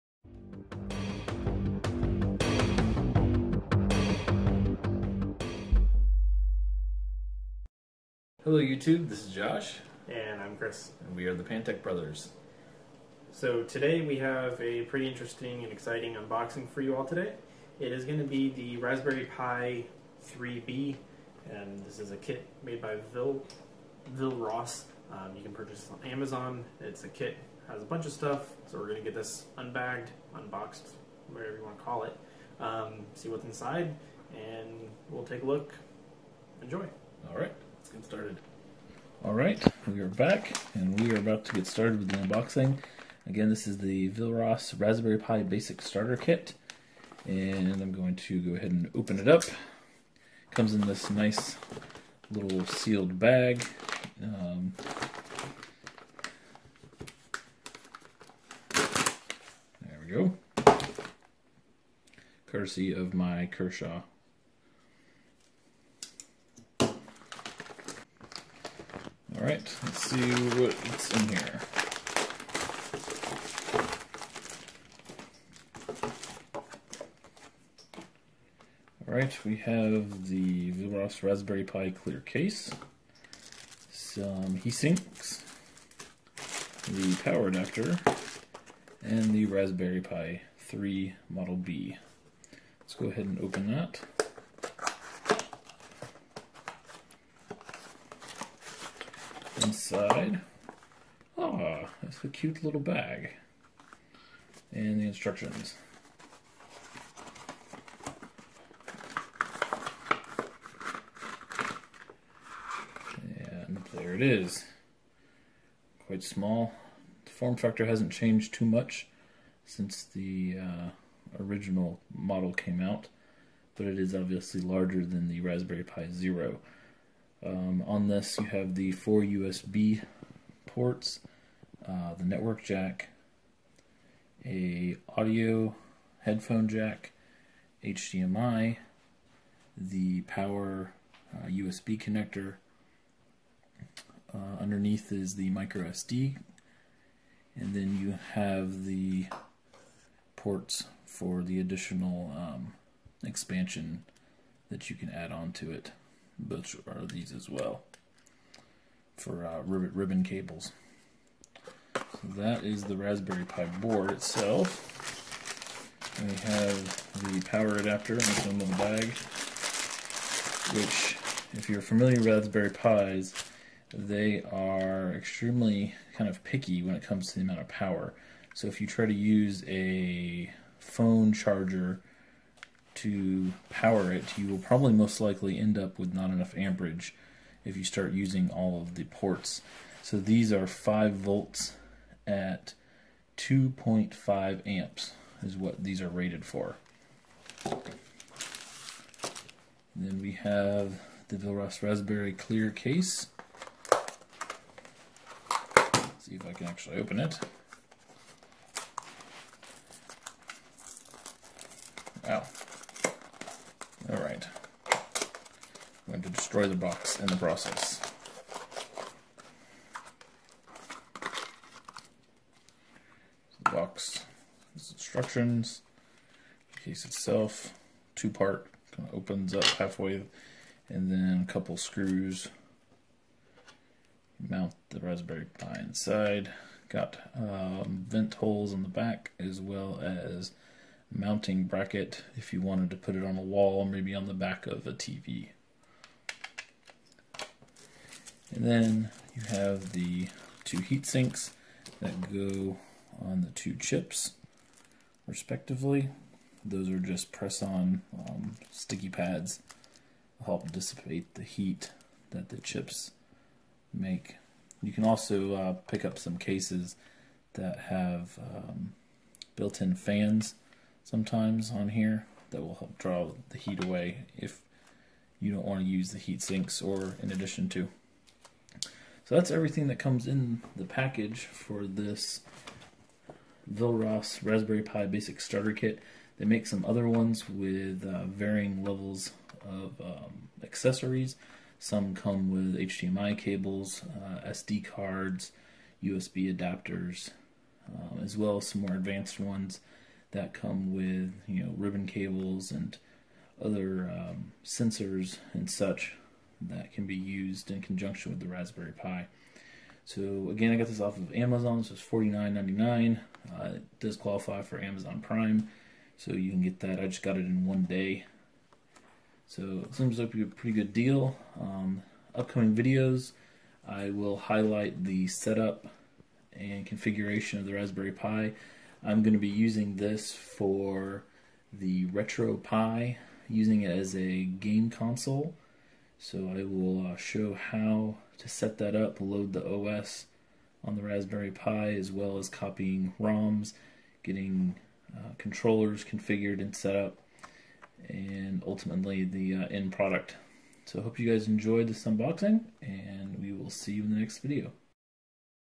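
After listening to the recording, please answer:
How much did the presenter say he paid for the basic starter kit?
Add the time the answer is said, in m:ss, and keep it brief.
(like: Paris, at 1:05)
$49.99, at 5:12.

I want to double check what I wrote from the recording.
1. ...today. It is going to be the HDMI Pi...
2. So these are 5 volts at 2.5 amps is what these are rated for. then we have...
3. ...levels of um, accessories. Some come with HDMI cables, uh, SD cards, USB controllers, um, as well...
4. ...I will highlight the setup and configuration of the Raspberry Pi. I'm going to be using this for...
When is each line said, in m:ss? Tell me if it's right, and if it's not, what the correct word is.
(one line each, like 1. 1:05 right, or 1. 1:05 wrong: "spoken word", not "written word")
1. 0:17 wrong: "Raspberry", not "HDMI"
2. 3:10 right
3. 4:48 wrong: "adapters", not "controllers"
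4. 5:23 right.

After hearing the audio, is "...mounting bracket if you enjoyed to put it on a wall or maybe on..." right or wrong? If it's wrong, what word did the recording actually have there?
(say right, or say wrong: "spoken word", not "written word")
wrong: "wanted", not "enjoyed".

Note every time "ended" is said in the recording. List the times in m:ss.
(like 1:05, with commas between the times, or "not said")
not said.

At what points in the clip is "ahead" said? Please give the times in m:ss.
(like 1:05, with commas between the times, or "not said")
0:48, 1:33.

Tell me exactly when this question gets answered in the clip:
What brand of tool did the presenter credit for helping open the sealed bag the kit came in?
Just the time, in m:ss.
1:03.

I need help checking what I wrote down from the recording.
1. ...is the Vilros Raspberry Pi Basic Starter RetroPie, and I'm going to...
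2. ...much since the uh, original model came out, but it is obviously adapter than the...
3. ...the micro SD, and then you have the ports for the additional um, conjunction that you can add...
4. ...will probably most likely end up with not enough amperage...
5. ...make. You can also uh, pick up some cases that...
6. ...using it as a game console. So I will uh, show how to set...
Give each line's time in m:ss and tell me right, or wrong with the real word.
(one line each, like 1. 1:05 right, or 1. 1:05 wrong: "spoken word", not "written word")
1. 0:43 wrong: "Kit", not "RetroPie"
2. 1:58 wrong: "larger", not "adapter"
3. 2:25 wrong: "expansion", not "conjunction"
4. 3:04 right
5. 4:23 right
6. 5:33 right.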